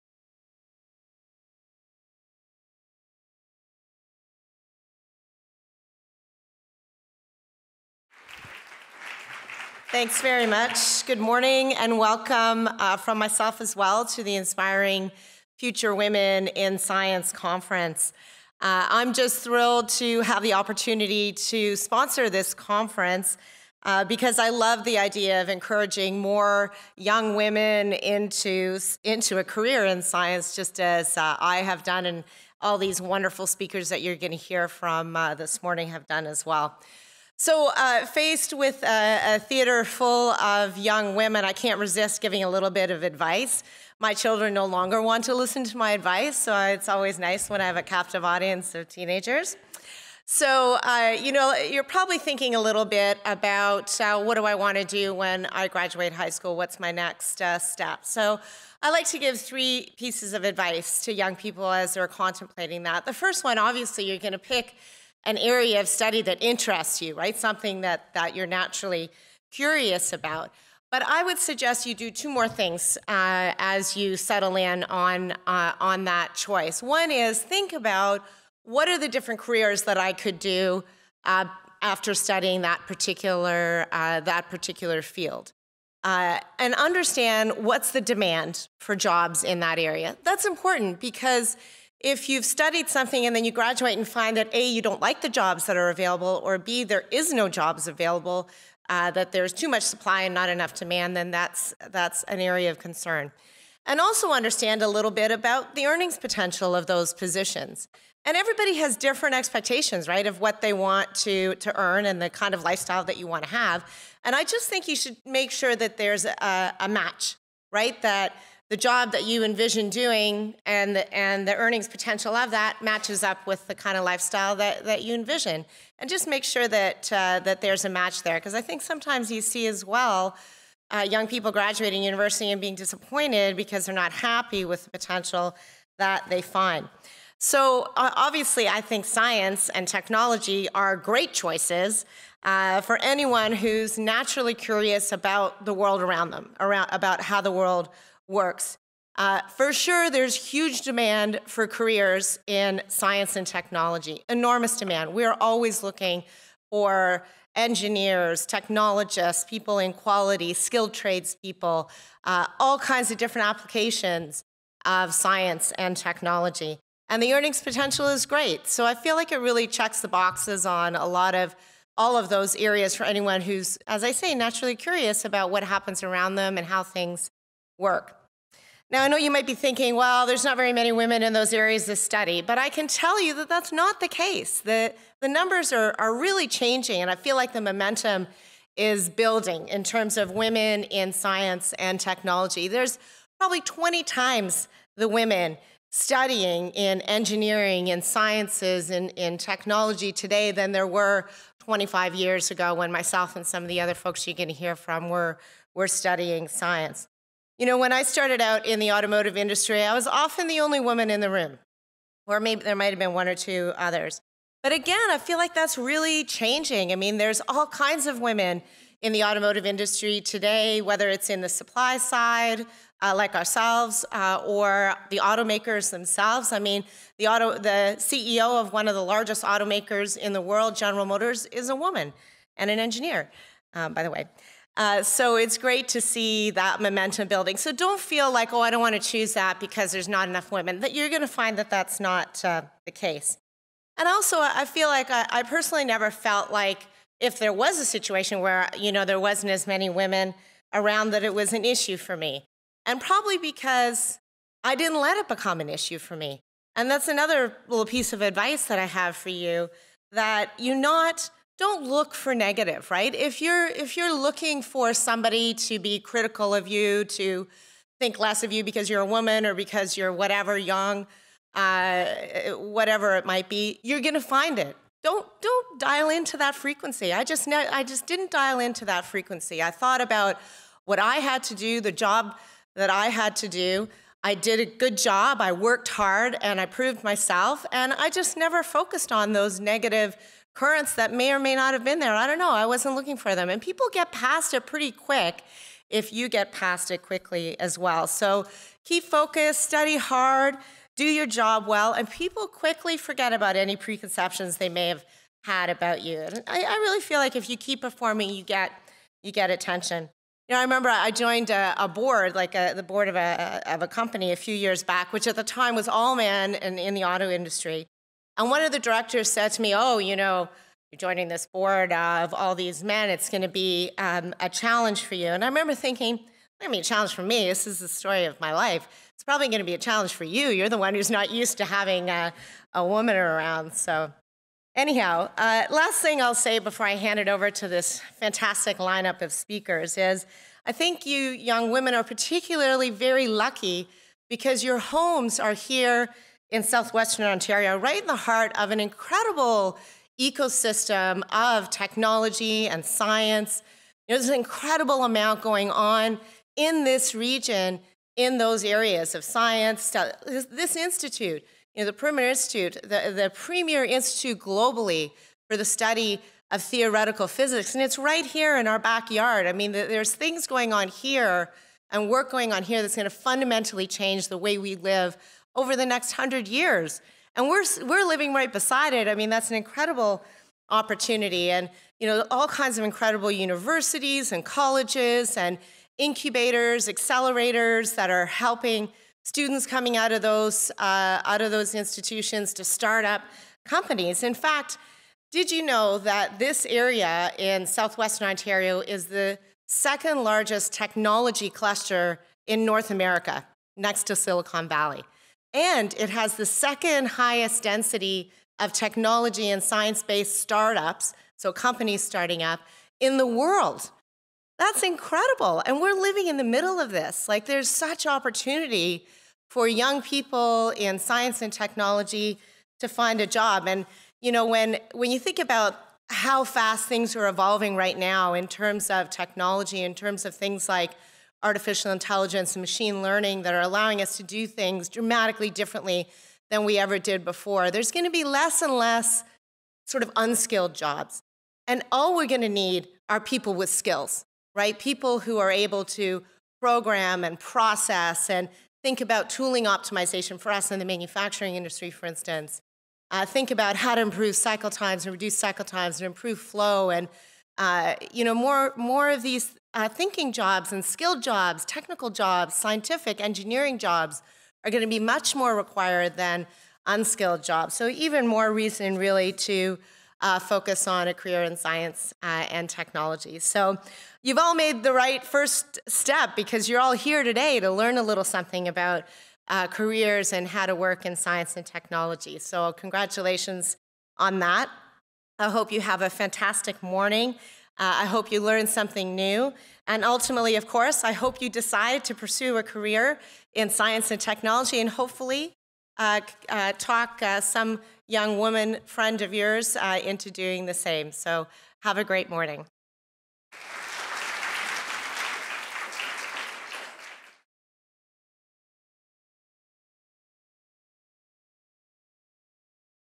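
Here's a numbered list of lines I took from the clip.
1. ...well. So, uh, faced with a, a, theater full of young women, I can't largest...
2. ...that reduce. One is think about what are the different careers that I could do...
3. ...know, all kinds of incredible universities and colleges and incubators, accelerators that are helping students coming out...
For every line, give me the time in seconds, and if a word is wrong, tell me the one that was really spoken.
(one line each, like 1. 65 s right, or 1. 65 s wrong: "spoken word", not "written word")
1. 36 s wrong: "resist", not "largest"
2. 76 s wrong: "choice", not "reduce"
3. 382 s right.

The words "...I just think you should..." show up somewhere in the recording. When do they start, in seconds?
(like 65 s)
114 s.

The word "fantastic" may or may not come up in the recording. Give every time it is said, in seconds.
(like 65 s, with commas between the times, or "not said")
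338 s, 486 s.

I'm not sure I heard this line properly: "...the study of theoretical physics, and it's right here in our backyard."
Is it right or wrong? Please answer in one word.
right.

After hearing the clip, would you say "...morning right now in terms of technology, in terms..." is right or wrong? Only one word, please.
wrong.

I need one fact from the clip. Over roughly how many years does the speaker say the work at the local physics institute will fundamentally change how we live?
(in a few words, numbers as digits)
100.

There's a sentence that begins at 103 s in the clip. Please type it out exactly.
And also understand a little bit about the earnings potential of those positions.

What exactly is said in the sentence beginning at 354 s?
There's an incredible amount going on in this region, in those areas of science.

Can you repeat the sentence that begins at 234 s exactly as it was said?
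Uh, so it's great to see that momentum building.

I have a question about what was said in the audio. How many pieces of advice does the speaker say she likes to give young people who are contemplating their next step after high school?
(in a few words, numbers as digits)
3.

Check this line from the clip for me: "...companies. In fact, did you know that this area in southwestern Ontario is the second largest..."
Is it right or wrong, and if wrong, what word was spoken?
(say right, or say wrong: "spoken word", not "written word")
right.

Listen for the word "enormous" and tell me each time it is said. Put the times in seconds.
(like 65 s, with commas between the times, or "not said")
154 s.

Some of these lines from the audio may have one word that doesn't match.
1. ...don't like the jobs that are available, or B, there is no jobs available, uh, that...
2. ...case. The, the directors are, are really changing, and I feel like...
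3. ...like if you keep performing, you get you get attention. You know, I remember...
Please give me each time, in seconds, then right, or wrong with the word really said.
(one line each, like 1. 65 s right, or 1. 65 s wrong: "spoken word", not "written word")
1. 94 s right
2. 184 s wrong: "numbers", not "directors"
3. 307 s right.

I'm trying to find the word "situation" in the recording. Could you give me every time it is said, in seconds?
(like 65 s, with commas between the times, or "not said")
247 s.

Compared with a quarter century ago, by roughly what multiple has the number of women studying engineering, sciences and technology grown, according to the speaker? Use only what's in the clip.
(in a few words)
20 times.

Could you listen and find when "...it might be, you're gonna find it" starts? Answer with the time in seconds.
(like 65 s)
273 s.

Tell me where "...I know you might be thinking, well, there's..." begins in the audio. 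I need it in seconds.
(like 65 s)
179 s.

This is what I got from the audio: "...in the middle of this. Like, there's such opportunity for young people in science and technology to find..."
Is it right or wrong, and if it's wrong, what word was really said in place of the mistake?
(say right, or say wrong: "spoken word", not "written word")
right.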